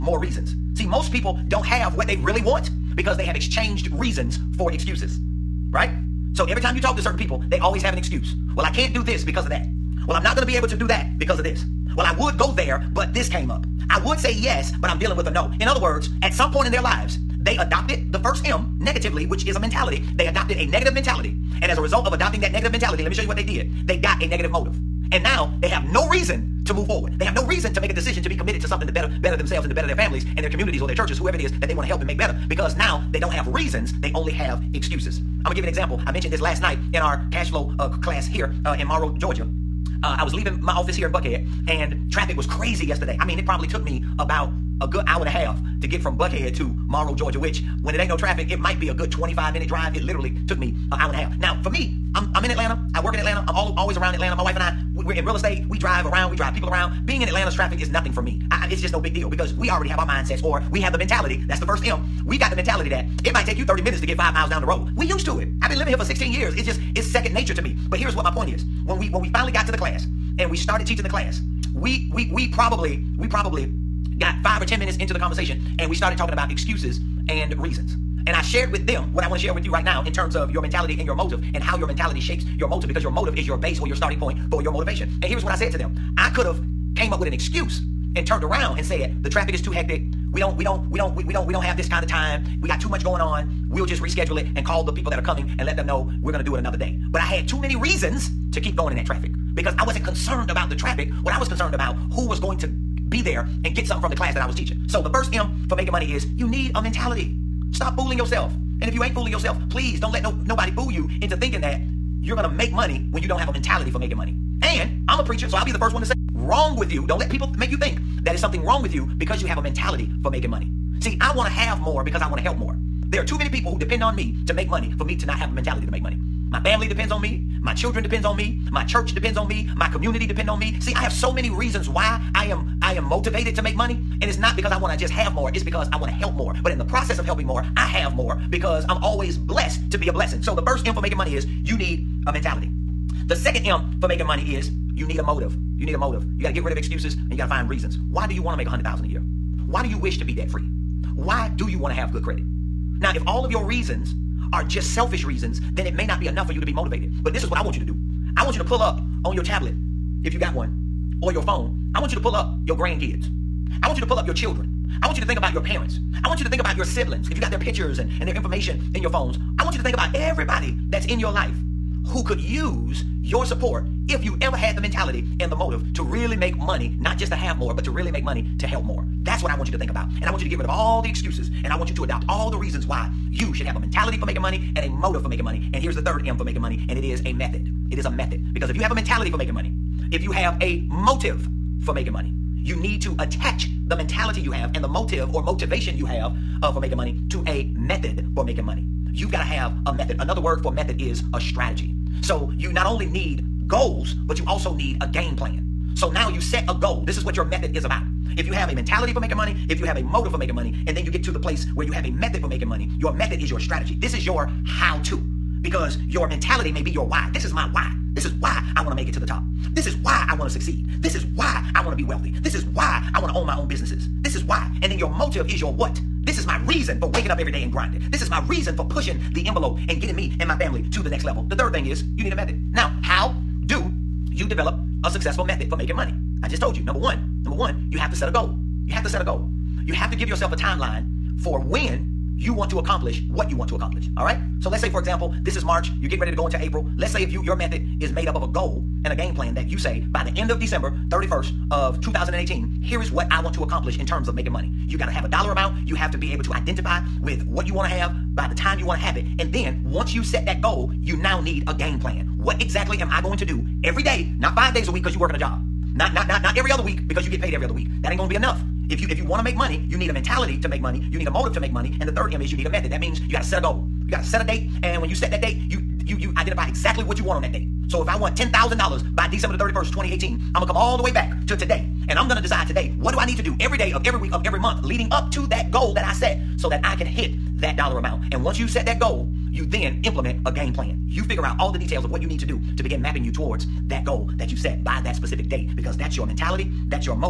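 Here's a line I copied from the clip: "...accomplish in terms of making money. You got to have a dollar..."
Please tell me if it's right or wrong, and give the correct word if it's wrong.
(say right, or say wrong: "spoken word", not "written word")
right.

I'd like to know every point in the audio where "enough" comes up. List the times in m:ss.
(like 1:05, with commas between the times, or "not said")
2:36, 4:28.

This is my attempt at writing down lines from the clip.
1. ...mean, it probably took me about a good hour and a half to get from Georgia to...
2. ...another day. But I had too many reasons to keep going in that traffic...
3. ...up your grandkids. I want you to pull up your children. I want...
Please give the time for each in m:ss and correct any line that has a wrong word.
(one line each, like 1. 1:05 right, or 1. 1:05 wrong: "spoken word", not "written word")
1. 0:43 wrong: "Buckhead", not "Georgia"
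2. 1:36 right
3. 2:42 right.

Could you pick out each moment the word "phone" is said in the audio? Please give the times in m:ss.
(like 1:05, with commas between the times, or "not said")
2:41, 2:49.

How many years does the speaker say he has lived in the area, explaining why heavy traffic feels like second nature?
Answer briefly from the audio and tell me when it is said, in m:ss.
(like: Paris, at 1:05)
16, at 1:06.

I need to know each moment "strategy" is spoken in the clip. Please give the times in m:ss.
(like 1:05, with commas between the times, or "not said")
3:21, 3:33.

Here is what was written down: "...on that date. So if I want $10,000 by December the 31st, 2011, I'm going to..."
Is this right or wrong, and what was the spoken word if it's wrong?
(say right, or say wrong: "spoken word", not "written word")
wrong: "2018", not "2011".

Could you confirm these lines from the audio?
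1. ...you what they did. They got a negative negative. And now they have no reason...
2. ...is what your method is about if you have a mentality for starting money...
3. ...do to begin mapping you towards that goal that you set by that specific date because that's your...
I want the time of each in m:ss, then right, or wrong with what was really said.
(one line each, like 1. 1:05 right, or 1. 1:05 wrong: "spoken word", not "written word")
1. 0:23 wrong: "motive", not "negative"
2. 3:27 wrong: "making", not "starting"
3. 4:52 right.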